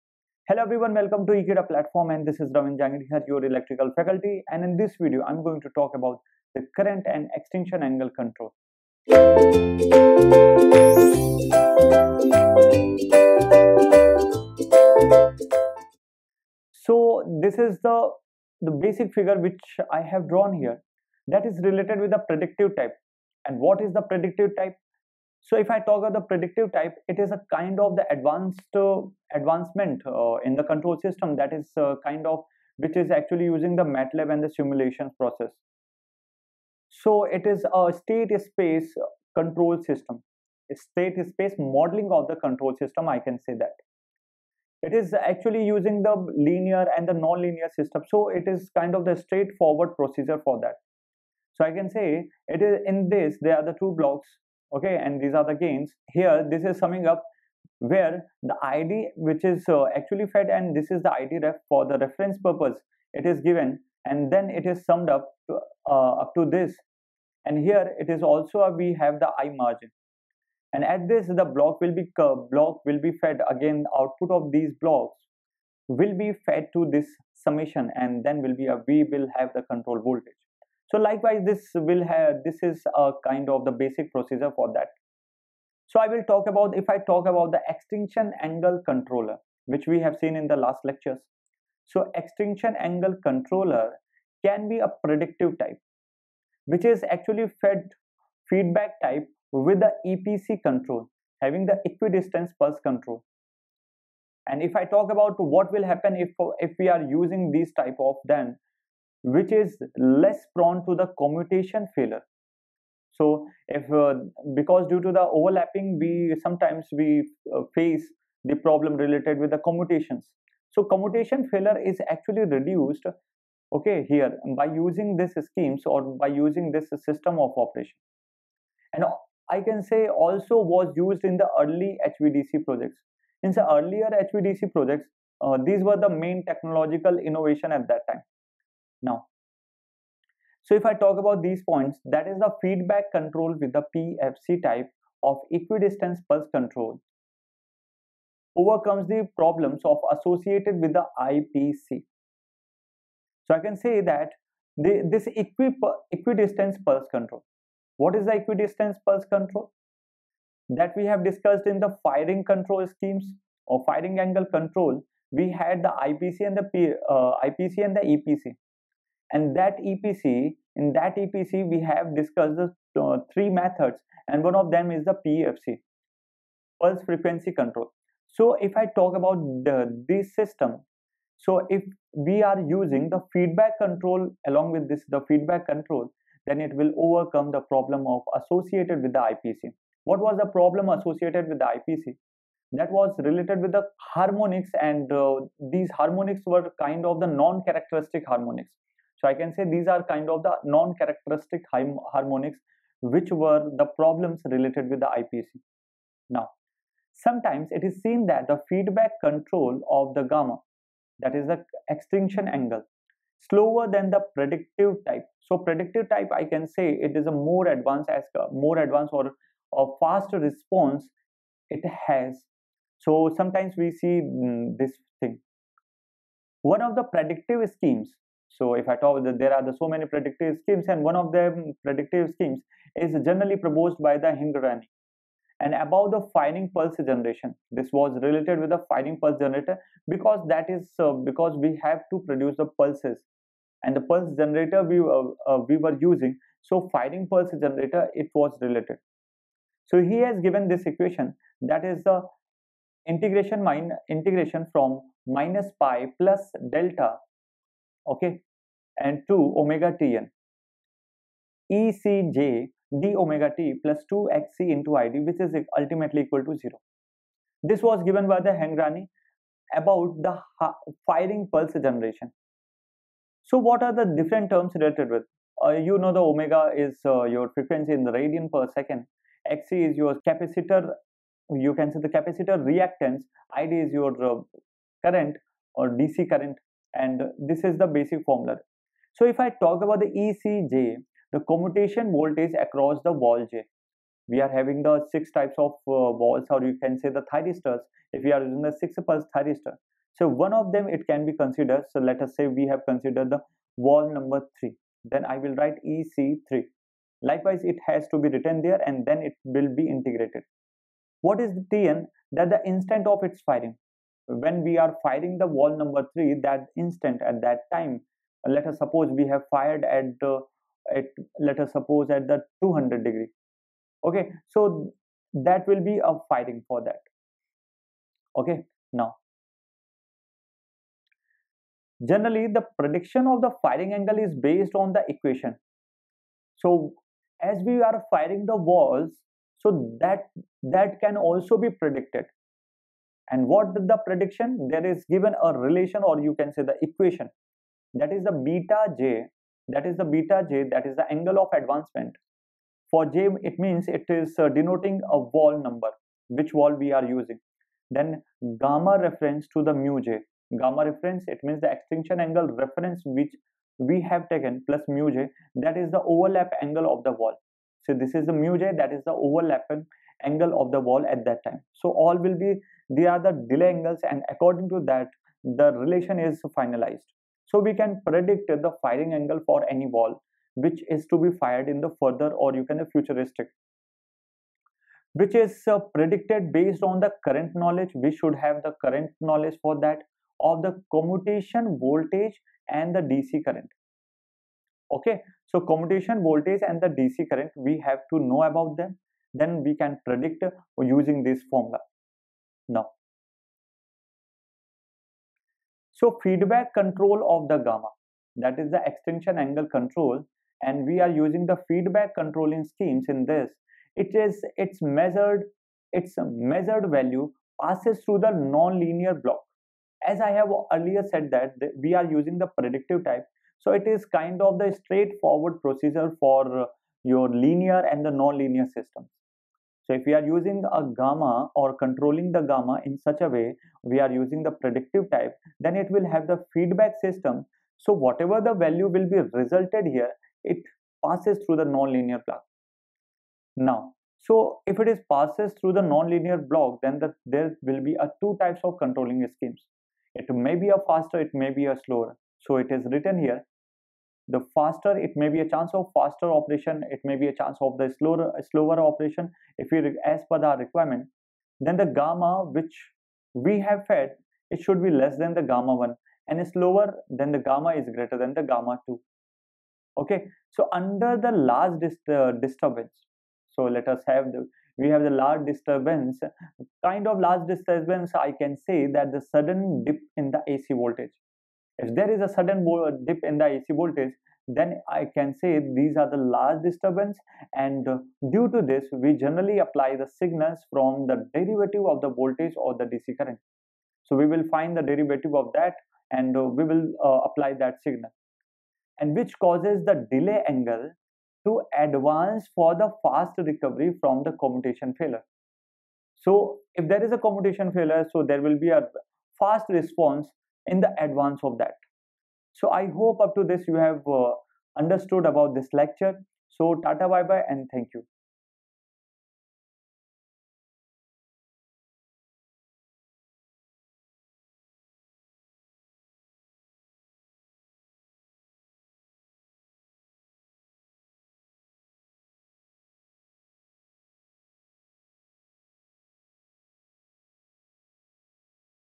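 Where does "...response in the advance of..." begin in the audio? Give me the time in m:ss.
8:29.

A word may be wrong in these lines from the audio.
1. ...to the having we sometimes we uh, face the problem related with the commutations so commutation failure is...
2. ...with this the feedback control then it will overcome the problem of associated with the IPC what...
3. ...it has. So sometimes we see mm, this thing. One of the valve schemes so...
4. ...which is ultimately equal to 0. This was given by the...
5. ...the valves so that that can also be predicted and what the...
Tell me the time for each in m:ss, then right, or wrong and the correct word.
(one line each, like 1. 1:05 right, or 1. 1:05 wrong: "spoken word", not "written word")
1. 1:54 wrong: "overlapping", not "having"
2. 3:04 right
3. 3:41 wrong: "predictive", not "valve"
4. 4:25 right
5. 5:38 right.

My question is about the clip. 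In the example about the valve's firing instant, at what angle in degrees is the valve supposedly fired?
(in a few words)
200 degrees.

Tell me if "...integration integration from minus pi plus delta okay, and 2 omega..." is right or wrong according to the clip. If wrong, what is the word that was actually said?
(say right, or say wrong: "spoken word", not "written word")
right.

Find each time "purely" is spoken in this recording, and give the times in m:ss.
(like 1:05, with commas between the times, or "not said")
not said.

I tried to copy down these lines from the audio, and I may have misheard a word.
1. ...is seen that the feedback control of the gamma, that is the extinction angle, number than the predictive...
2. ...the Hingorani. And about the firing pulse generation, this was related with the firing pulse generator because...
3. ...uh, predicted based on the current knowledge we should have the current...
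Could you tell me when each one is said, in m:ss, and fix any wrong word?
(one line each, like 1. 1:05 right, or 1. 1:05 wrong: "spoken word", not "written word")
1. 3:27 wrong: "slower", not "number"
2. 3:54 right
3. 6:25 right.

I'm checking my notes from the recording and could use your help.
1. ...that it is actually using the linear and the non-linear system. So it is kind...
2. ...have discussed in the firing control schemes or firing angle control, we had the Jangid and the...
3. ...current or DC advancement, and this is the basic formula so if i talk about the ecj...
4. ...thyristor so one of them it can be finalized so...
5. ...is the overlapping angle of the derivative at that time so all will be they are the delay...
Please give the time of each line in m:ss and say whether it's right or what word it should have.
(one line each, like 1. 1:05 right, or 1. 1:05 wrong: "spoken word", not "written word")
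1. 0:43 right
2. 2:41 wrong: "IPC", not "Jangid"
3. 4:45 wrong: "current", not "advancement"
4. 4:59 wrong: "considered", not "finalized"
5. 6:08 wrong: "valve", not "derivative".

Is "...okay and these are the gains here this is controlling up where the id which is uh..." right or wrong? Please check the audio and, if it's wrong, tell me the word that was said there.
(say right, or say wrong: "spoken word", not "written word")
wrong: "summing", not "controlling".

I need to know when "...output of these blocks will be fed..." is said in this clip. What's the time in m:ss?
1:13.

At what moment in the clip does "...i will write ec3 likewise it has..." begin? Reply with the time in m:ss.
5:05.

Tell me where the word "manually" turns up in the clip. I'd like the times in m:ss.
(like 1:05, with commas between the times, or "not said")
not said.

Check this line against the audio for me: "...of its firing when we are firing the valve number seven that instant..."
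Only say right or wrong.
wrong.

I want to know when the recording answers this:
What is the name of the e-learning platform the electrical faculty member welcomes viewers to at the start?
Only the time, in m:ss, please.
0:01.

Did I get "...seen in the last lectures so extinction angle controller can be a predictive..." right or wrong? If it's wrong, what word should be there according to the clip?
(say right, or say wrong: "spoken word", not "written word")
right.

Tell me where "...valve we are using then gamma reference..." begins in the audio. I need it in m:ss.
5:56.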